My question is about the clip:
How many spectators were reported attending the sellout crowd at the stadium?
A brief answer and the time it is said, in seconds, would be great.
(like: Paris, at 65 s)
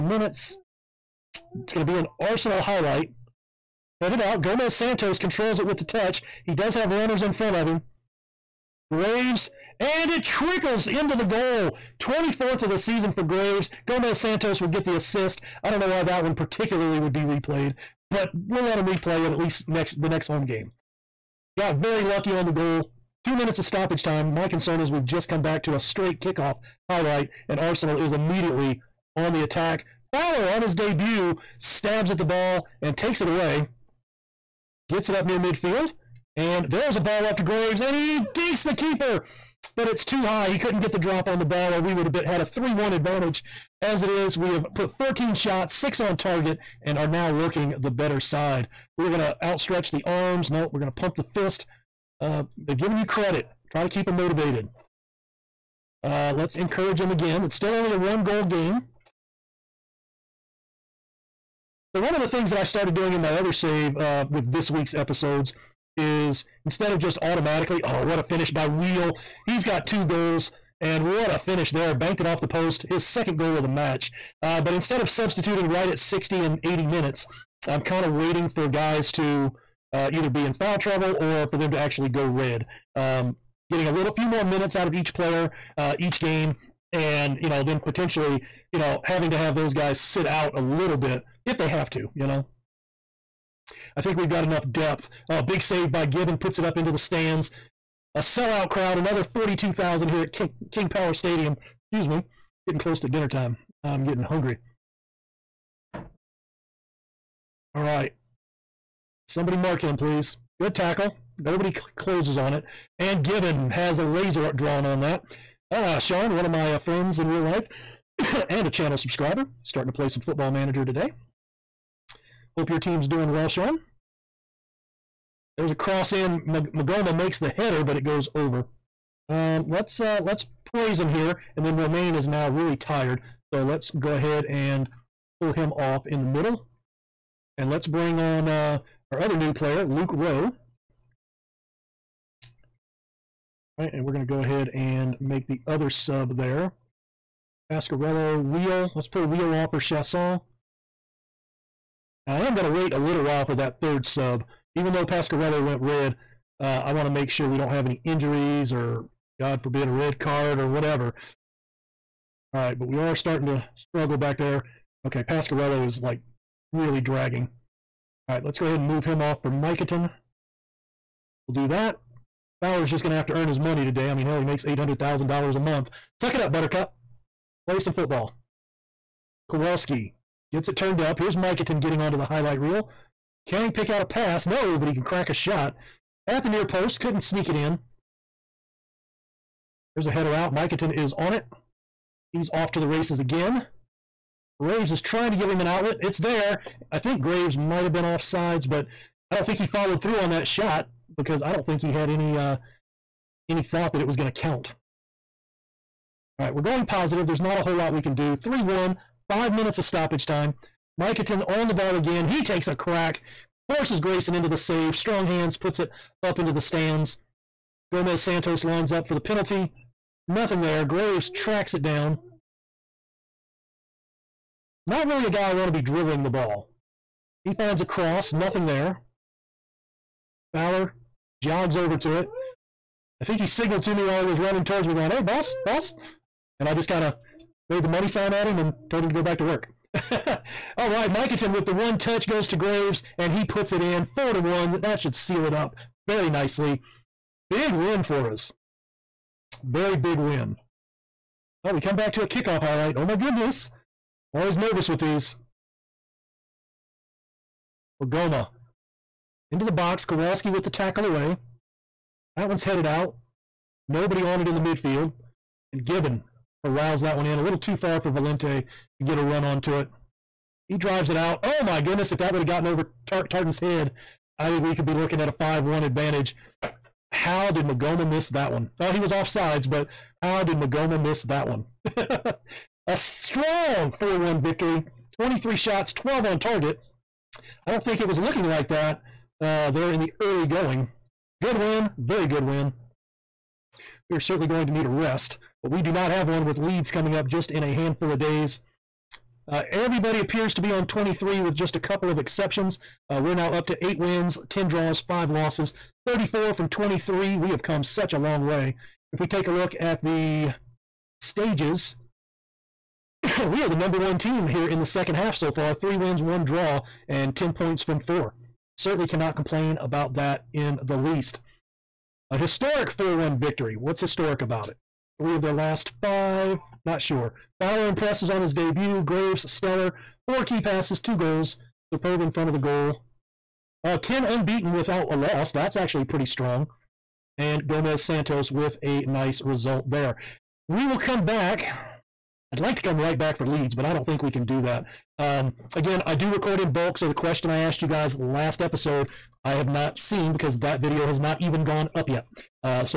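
42,000, at 99 s.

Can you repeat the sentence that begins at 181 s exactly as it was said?
Here's Mikaton getting onto the highlight reel.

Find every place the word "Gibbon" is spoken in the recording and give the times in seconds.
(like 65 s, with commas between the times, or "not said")
96 s, 113 s, 265 s.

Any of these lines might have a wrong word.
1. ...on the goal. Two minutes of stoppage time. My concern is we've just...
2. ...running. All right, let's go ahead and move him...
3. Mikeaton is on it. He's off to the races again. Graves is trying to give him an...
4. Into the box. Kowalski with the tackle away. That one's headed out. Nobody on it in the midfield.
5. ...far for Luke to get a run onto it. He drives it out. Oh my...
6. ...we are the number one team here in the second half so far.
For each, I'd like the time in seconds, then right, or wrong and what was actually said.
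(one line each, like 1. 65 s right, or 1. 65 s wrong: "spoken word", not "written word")
1. 22 s right
2. 167 s wrong: "dragging", not "running"
3. 190 s right
4. 259 s right
5. 267 s wrong: "Valente", not "Luke"
6. 313 s right.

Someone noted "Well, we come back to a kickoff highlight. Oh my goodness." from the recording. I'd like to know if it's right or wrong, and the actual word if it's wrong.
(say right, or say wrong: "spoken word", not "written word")
right.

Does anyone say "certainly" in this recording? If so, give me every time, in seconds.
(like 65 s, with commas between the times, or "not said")
294 s, 318 s.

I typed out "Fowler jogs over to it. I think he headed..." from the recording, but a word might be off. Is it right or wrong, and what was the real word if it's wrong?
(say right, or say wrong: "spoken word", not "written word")
wrong: "signaled", not "headed".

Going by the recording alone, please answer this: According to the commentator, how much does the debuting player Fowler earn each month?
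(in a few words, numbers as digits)
$800,000.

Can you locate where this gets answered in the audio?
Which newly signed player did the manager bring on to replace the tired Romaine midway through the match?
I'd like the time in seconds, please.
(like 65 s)
139 s.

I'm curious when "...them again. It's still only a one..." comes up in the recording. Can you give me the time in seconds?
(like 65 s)
56 s.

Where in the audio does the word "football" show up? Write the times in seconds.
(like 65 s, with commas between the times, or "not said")
120 s, 177 s.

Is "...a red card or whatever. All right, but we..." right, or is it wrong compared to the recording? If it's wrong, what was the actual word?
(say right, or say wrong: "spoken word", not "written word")
right.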